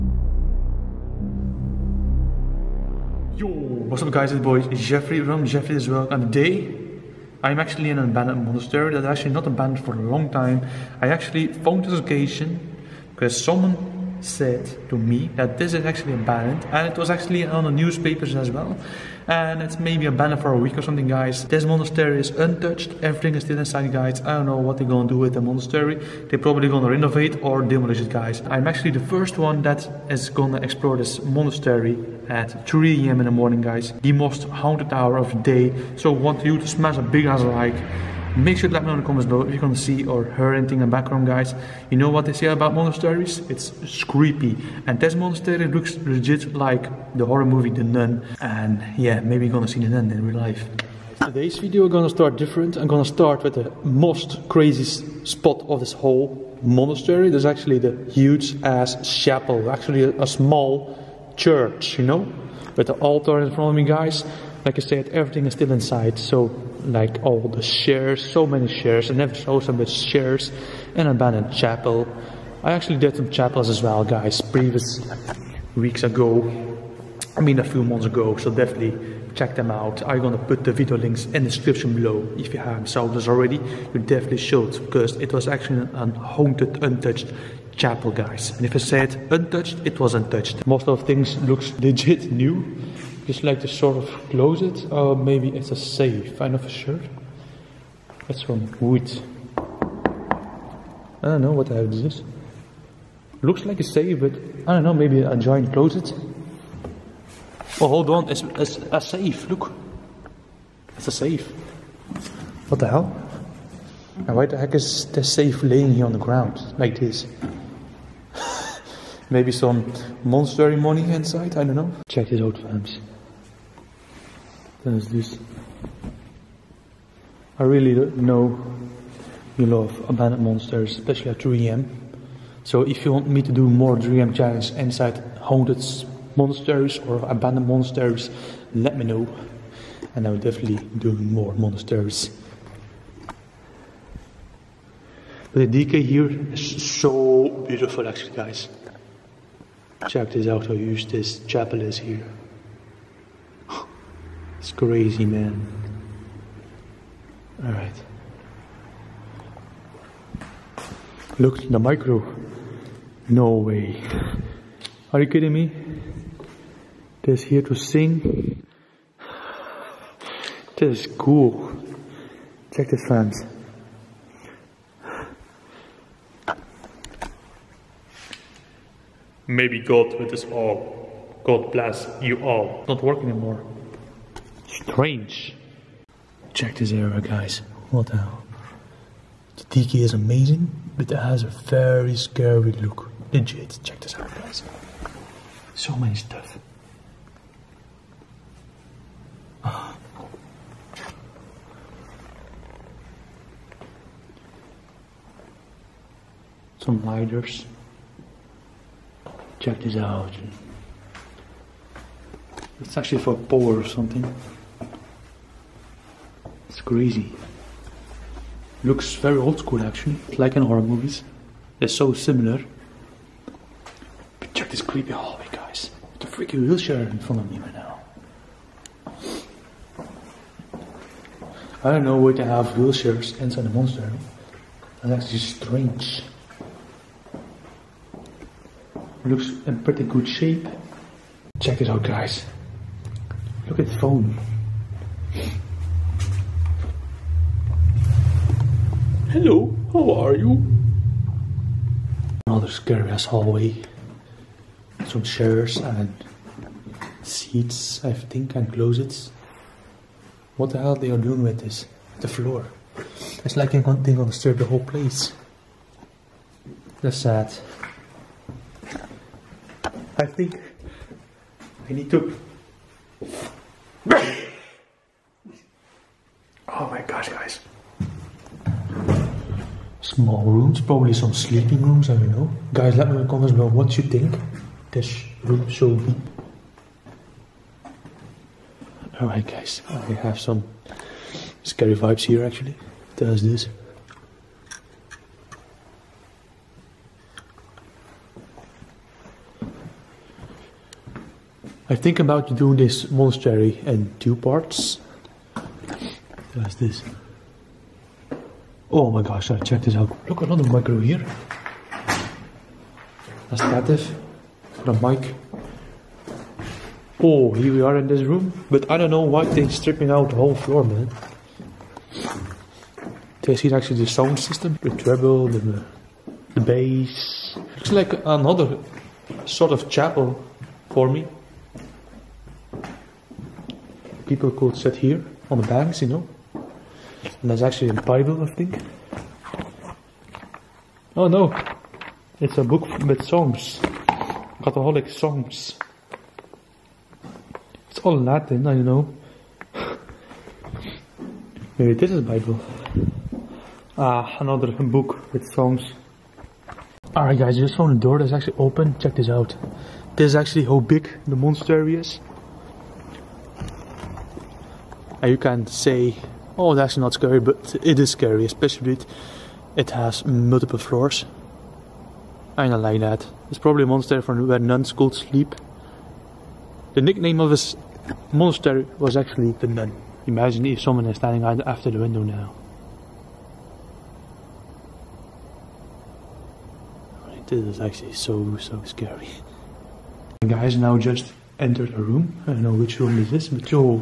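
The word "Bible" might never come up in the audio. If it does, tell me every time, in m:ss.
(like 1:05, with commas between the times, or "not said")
5:38, 5:52.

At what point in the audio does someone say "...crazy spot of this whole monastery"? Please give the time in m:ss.
0:54.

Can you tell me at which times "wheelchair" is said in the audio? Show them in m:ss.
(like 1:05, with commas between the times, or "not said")
3:46, 3:52.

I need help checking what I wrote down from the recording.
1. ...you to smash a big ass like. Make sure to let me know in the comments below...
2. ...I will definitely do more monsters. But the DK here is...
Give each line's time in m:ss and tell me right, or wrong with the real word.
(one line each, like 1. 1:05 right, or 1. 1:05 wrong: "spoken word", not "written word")
1. 0:36 right
2. 2:20 right.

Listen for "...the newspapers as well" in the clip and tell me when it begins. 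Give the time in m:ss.
0:17.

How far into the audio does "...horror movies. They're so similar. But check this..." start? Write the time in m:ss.
3:40.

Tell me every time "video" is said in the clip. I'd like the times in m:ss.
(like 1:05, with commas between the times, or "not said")
0:51, 1:20.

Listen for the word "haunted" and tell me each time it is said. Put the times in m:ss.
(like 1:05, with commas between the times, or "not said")
0:34, 1:26, 2:15.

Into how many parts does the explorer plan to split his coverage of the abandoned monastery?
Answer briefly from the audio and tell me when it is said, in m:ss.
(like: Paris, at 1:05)
2, at 5:04.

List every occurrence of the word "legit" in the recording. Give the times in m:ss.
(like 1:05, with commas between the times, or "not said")
0:45, 1:31, 3:13.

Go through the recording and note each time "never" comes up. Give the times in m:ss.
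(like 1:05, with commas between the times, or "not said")
1:09.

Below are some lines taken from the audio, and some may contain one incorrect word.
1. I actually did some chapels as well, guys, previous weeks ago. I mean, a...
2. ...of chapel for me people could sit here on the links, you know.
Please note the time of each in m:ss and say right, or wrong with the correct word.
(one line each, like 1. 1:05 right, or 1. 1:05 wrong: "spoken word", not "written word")
1. 1:12 right
2. 5:29 wrong: "banks", not "links".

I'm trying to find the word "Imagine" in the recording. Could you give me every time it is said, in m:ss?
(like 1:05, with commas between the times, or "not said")
6:20.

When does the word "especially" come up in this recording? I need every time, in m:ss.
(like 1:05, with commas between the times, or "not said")
2:10, 6:08.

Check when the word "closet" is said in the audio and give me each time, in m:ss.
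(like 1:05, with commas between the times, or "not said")
1:34, 1:45, 4:18.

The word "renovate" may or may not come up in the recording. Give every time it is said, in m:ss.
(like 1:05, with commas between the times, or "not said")
0:26.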